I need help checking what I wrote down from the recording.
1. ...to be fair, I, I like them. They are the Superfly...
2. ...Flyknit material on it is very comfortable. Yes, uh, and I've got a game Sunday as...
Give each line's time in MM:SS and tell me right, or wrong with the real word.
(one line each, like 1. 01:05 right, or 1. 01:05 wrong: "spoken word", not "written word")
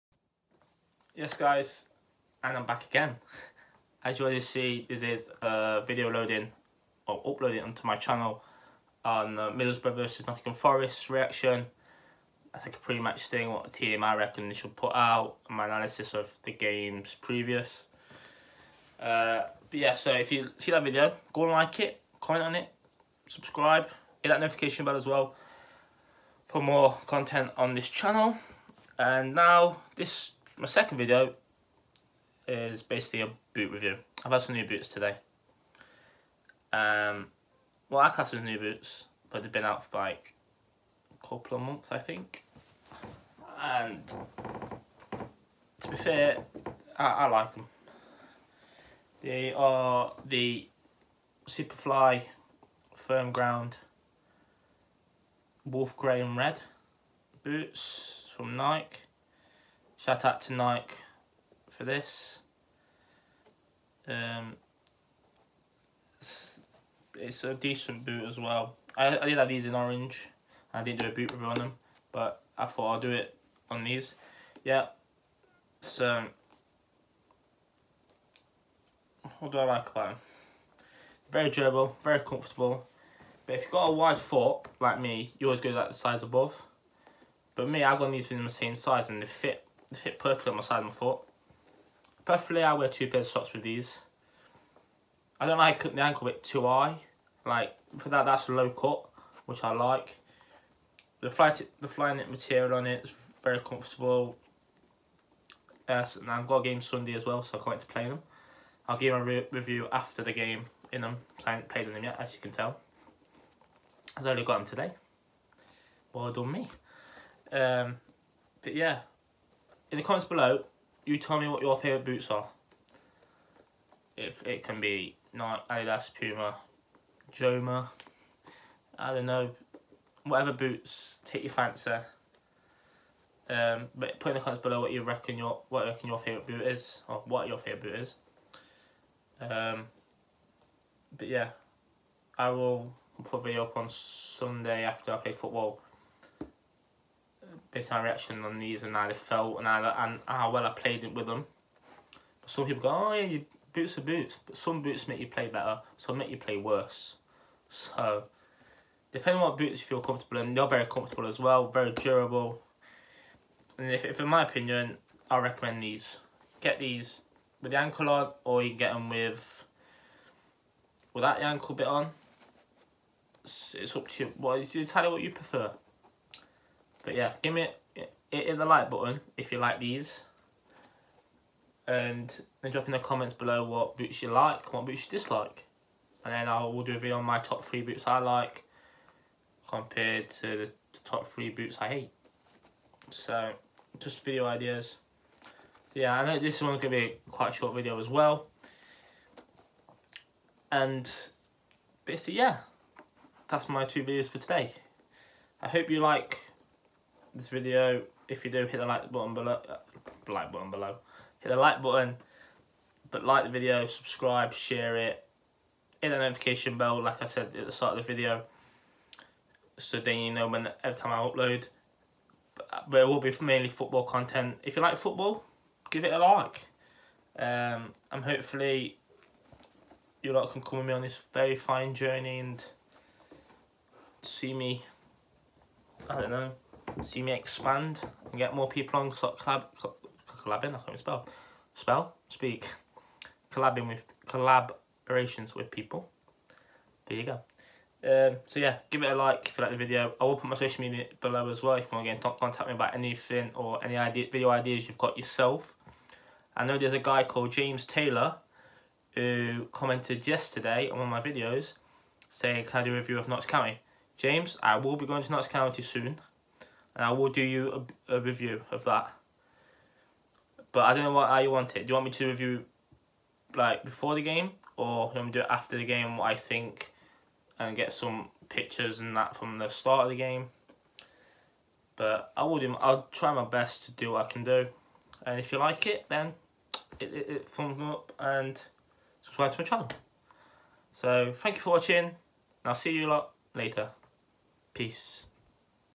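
1. 00:45 right
2. 01:41 right.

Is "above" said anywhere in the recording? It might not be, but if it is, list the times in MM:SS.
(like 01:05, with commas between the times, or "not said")
01:26.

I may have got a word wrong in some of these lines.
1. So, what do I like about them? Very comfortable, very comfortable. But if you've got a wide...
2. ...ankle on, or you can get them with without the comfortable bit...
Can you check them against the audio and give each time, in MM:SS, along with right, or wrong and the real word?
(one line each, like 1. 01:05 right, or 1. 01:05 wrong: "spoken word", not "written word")
1. 01:15 wrong: "durable", not "comfortable"
2. 02:47 wrong: "ankle", not "comfortable".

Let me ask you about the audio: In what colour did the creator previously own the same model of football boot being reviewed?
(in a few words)
Orange.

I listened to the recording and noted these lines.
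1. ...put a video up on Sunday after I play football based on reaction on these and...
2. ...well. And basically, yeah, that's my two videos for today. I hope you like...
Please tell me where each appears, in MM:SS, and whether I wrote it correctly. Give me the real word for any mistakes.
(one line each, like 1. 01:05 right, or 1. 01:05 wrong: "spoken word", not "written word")
1. 02:23 right
2. 03:18 right.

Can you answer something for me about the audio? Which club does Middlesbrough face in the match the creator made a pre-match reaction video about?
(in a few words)
Nottingham Forest.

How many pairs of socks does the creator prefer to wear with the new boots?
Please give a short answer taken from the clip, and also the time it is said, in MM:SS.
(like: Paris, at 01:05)
2, at 01:32.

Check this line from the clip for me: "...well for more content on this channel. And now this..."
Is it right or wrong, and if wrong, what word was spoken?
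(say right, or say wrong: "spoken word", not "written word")
right.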